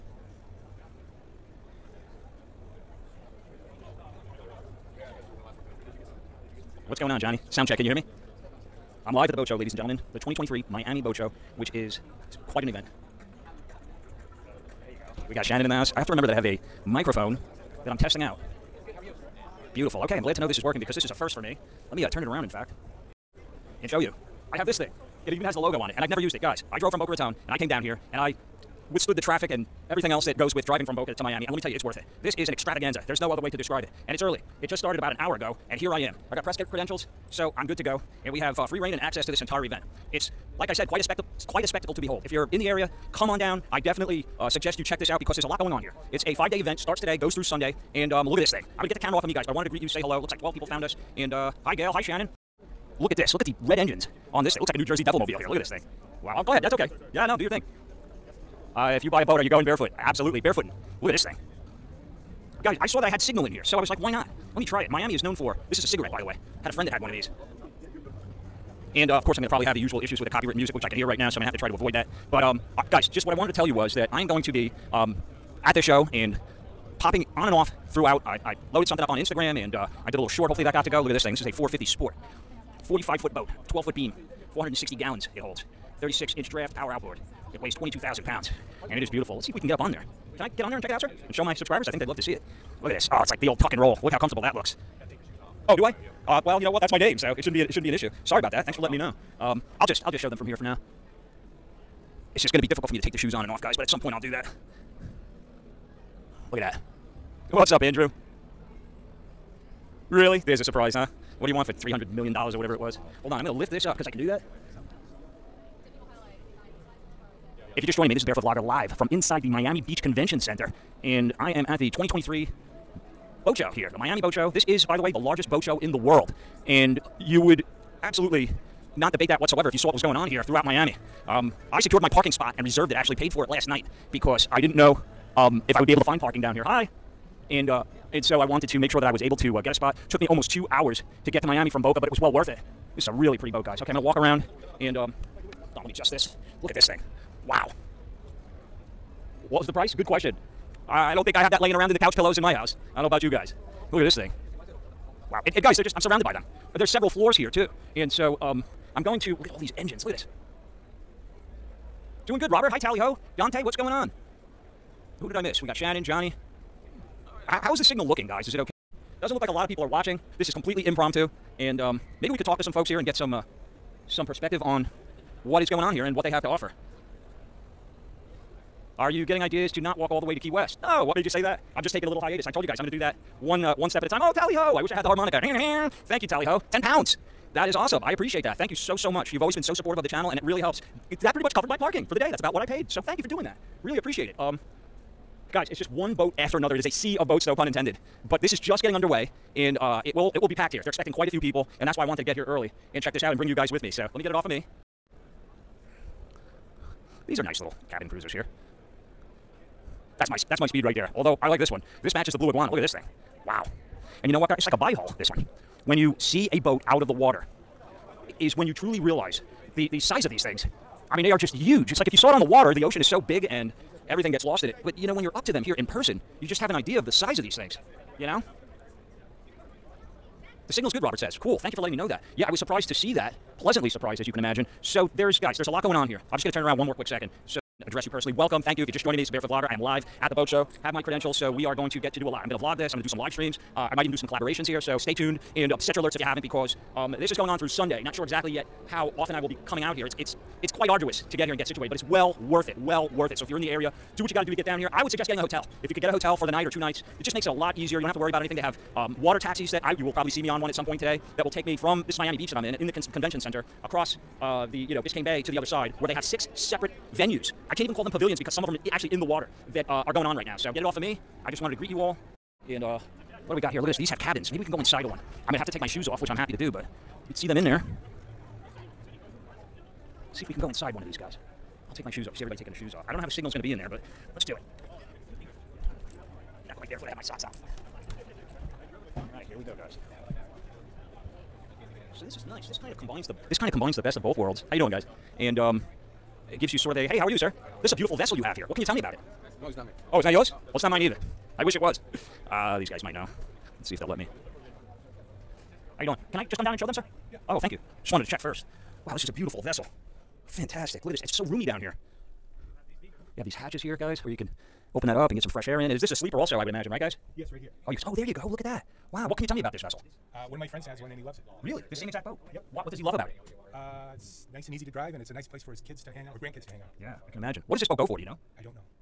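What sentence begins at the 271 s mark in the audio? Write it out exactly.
I just wanted to greet you all.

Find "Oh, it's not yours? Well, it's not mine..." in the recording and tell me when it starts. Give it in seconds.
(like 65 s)
300 s.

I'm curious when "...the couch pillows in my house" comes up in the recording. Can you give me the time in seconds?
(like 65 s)
151 s.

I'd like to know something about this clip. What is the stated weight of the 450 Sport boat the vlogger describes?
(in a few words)
22,000 pounds.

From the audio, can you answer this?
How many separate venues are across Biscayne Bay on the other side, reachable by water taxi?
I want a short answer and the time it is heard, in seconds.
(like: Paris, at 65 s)
6, at 266 s.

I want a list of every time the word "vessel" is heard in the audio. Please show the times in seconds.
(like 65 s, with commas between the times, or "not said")
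298 s, 309 s, 319 s.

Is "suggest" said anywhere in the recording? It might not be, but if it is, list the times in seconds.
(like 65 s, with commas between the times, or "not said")
44 s, 255 s.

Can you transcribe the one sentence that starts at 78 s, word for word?
I, I loaded something up on Instagram and.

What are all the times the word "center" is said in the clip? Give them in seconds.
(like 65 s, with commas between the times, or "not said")
120 s, 263 s.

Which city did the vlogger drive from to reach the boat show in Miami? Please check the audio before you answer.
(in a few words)
Boca Raton.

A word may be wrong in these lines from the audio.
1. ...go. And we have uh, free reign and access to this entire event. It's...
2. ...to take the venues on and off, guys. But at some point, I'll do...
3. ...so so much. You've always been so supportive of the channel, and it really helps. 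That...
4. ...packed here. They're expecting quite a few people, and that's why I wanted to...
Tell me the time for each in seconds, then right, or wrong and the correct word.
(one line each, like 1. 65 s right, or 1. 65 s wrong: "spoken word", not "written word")
1. 37 s right
2. 102 s wrong: "shoes", not "venues"
3. 188 s right
4. 200 s right.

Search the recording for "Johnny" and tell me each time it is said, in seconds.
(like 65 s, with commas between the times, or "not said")
7 s, 166 s.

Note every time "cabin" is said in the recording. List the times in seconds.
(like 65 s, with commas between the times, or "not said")
207 s, 274 s.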